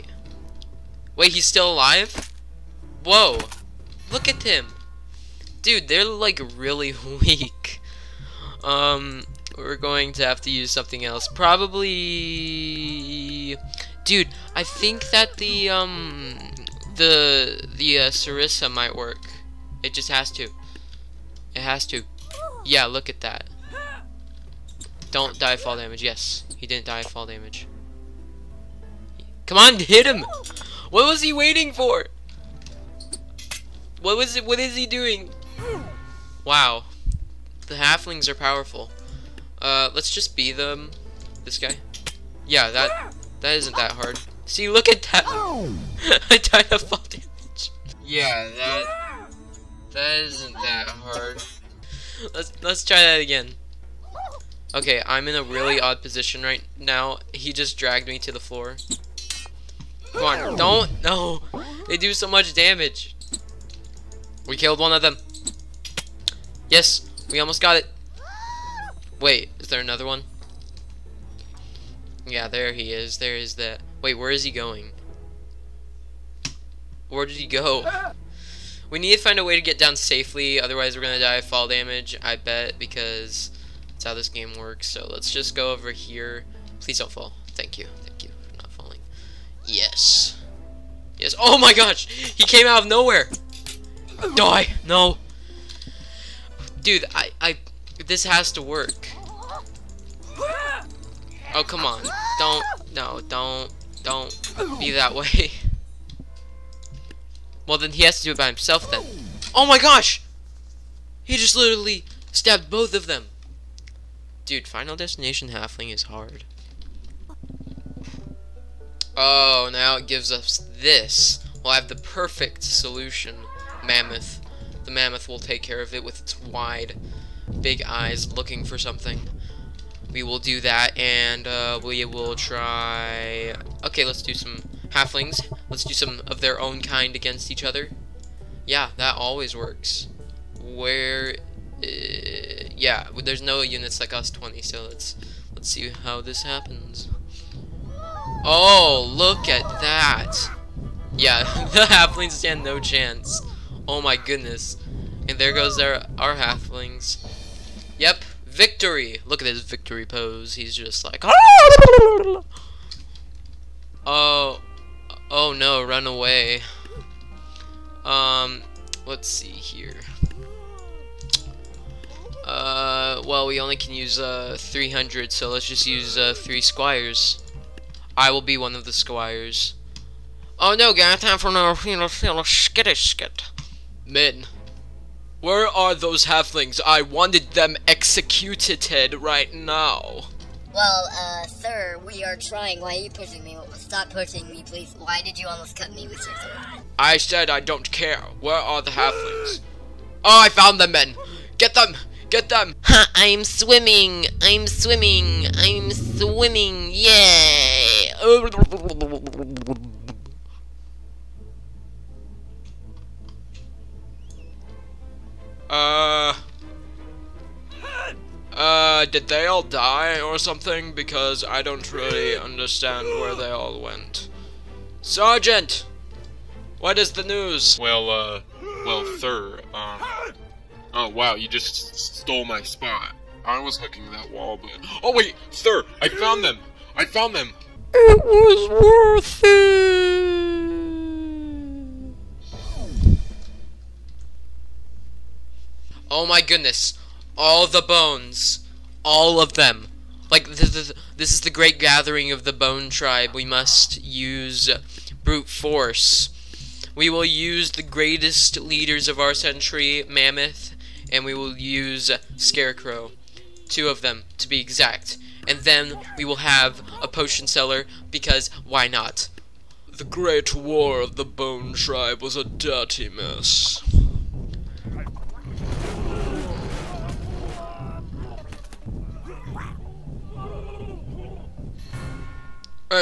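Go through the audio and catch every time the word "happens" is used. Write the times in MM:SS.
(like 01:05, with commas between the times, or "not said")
02:26.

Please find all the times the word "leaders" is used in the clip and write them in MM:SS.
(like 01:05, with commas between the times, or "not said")
04:18.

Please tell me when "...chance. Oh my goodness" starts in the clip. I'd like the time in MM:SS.
02:32.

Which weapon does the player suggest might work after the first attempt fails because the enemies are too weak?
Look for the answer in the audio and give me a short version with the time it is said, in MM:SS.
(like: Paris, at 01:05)
Sarissa, at 00:18.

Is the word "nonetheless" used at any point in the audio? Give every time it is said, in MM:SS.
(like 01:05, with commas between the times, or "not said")
not said.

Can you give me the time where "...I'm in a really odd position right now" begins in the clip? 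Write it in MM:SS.
00:55.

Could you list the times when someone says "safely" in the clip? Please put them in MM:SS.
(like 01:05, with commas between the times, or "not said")
01:19.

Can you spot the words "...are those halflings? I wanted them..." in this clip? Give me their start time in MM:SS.
03:05.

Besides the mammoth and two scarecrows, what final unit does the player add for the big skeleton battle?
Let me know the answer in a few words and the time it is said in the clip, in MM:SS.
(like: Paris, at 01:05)
potion seller, at 04:27.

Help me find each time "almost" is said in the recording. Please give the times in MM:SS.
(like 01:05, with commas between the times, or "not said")
01:07, 03:15.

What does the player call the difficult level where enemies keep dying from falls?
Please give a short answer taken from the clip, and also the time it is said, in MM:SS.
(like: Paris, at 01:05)
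Final Destination Halfling, at 01:54.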